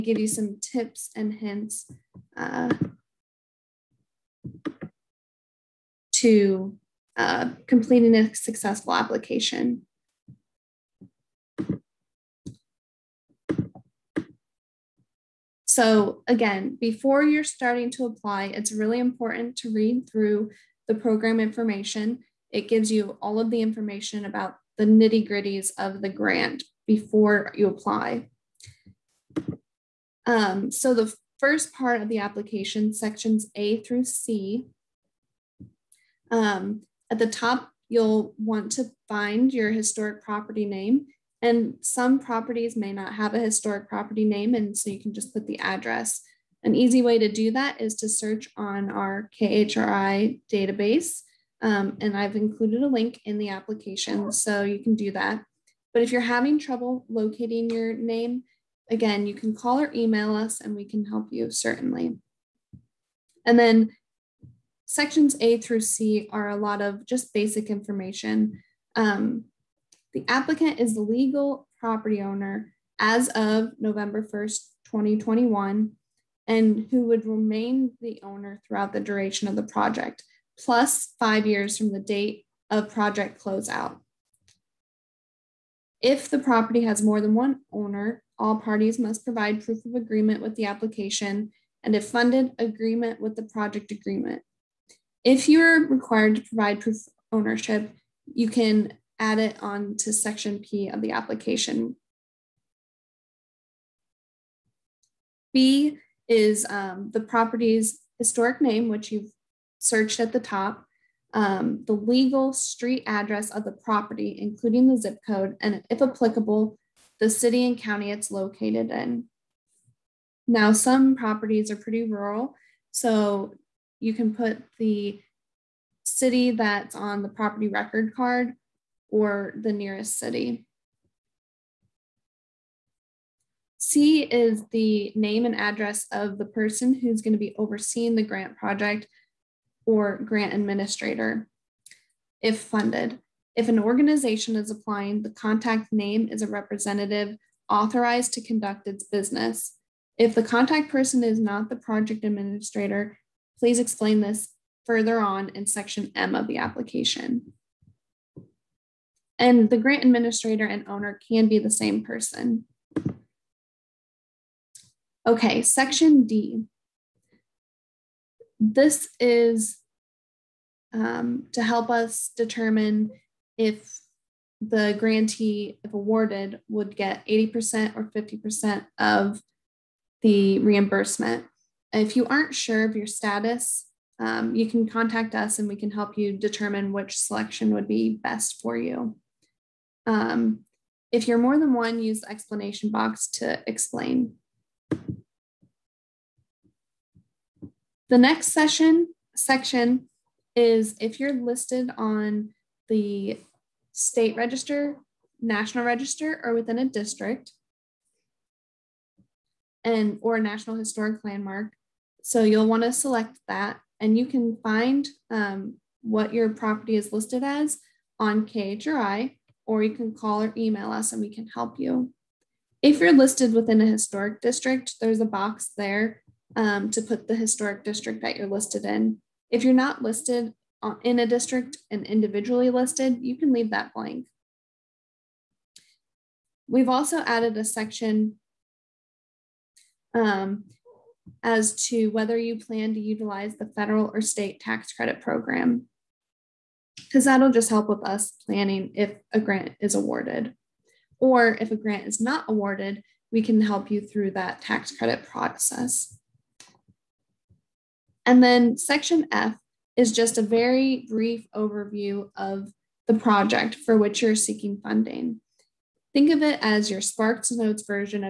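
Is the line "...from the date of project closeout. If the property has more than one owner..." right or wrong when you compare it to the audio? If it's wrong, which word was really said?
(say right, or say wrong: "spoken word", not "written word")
right.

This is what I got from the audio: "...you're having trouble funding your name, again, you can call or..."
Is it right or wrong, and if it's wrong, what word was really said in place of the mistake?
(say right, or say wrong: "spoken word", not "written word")
wrong: "locating", not "funding".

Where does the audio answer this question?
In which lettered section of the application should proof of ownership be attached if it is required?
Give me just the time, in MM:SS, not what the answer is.
01:40.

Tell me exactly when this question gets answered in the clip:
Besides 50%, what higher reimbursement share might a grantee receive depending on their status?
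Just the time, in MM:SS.
02:57.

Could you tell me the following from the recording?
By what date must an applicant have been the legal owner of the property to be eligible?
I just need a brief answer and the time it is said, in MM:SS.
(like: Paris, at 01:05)
November 1st, 2021, at 01:13.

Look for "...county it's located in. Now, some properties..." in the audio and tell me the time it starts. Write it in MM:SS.
01:57.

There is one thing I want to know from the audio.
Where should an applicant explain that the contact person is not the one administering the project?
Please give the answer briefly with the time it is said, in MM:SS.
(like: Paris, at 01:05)
Section M, at 02:35.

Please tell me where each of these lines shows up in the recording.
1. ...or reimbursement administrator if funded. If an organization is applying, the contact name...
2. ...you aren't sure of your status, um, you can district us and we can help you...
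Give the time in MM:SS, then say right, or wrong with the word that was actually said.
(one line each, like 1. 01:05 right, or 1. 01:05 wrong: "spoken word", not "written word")
1. 02:19 wrong: "grant", not "reimbursement"
2. 03:02 wrong: "contact", not "district".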